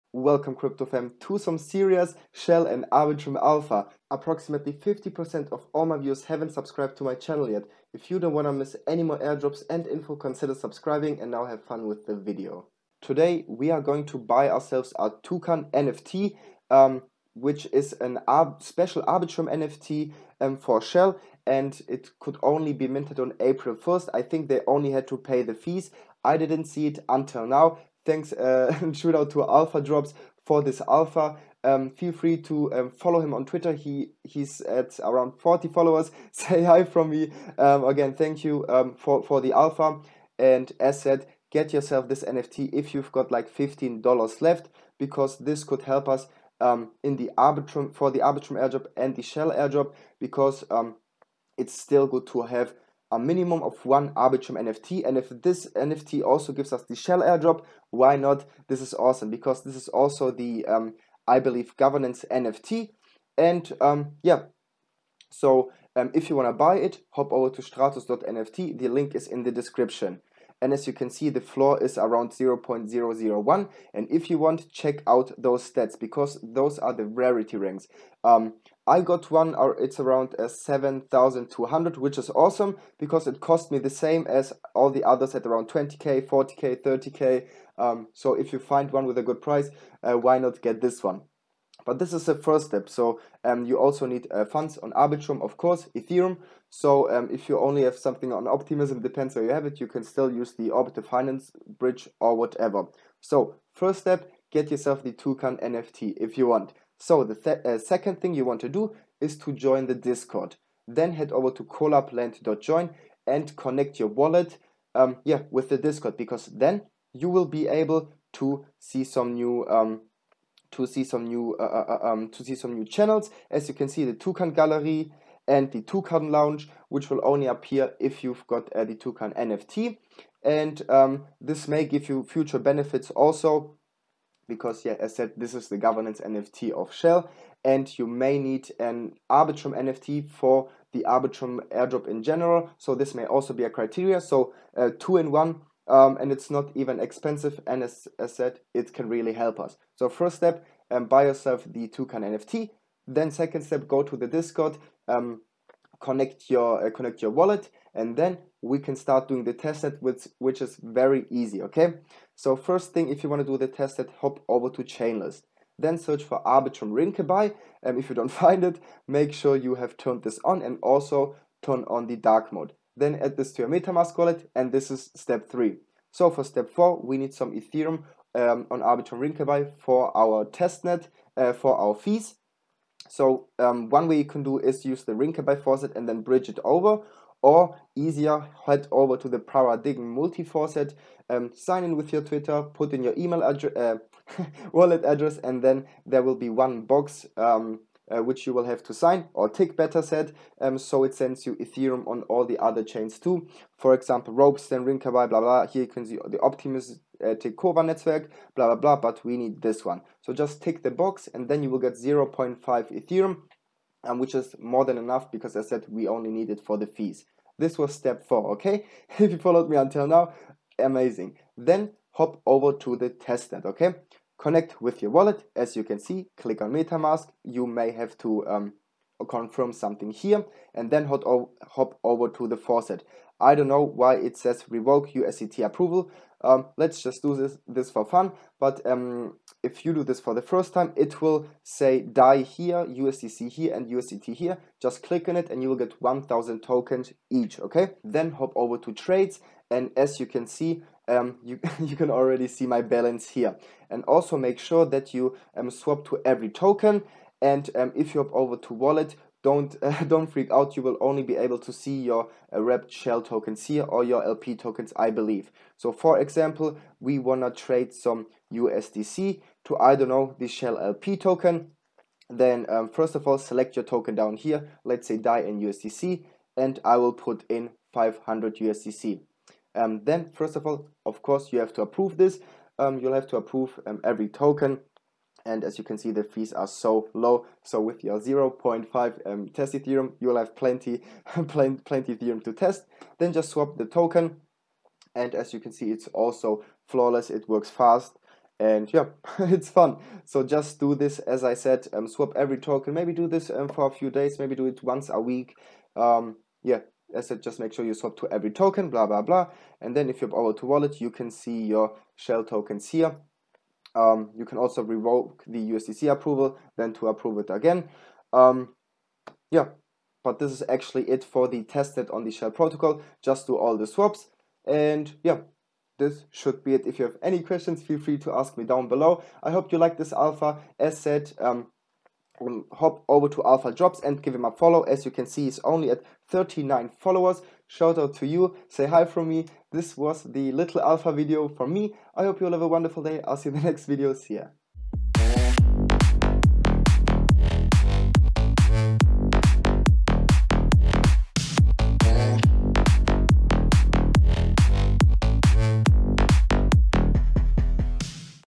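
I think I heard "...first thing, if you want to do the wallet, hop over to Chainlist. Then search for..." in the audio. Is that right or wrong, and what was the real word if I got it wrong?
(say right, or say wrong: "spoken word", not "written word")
wrong: "testnet", not "wallet".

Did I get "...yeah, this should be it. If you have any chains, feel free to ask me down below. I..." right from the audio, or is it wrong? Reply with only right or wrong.
wrong.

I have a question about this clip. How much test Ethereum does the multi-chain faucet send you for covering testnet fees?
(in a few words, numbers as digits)
0.5 ethereum.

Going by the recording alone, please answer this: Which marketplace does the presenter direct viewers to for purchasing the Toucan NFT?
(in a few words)
stratos.nft.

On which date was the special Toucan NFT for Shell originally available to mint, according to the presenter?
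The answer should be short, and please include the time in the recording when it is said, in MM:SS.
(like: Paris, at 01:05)
April 1st, at 00:23.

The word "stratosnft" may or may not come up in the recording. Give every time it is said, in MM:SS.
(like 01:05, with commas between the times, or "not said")
01:07.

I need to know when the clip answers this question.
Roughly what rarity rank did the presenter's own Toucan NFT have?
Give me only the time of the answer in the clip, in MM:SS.
01:20.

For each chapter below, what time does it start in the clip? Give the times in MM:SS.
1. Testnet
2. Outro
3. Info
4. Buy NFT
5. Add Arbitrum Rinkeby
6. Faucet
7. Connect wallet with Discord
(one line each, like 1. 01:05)
1. 03:41
2. 05:00
3. 00:12
4. 01:05
5. 02:42
6. 02:55
7. 01:46.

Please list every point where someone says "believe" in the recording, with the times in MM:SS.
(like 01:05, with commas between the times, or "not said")
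01:01, 04:25.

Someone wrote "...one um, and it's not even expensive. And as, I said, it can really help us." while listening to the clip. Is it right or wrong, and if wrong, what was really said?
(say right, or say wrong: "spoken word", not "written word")
right.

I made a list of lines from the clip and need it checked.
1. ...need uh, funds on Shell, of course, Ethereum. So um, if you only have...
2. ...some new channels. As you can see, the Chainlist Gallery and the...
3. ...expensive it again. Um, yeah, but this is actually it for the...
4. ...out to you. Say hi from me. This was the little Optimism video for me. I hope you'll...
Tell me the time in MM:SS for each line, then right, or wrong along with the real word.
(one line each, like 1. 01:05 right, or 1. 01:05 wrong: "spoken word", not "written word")
1. 01:34 wrong: "Arbitrum", not "Shell"
2. 02:02 wrong: "Toucan", not "Chainlist"
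3. 05:17 wrong: "approve", not "expensive"
4. 05:37 wrong: "Alpha", not "Optimism".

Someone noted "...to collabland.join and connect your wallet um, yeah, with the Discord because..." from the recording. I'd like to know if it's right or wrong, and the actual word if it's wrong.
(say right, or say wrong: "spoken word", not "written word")
right.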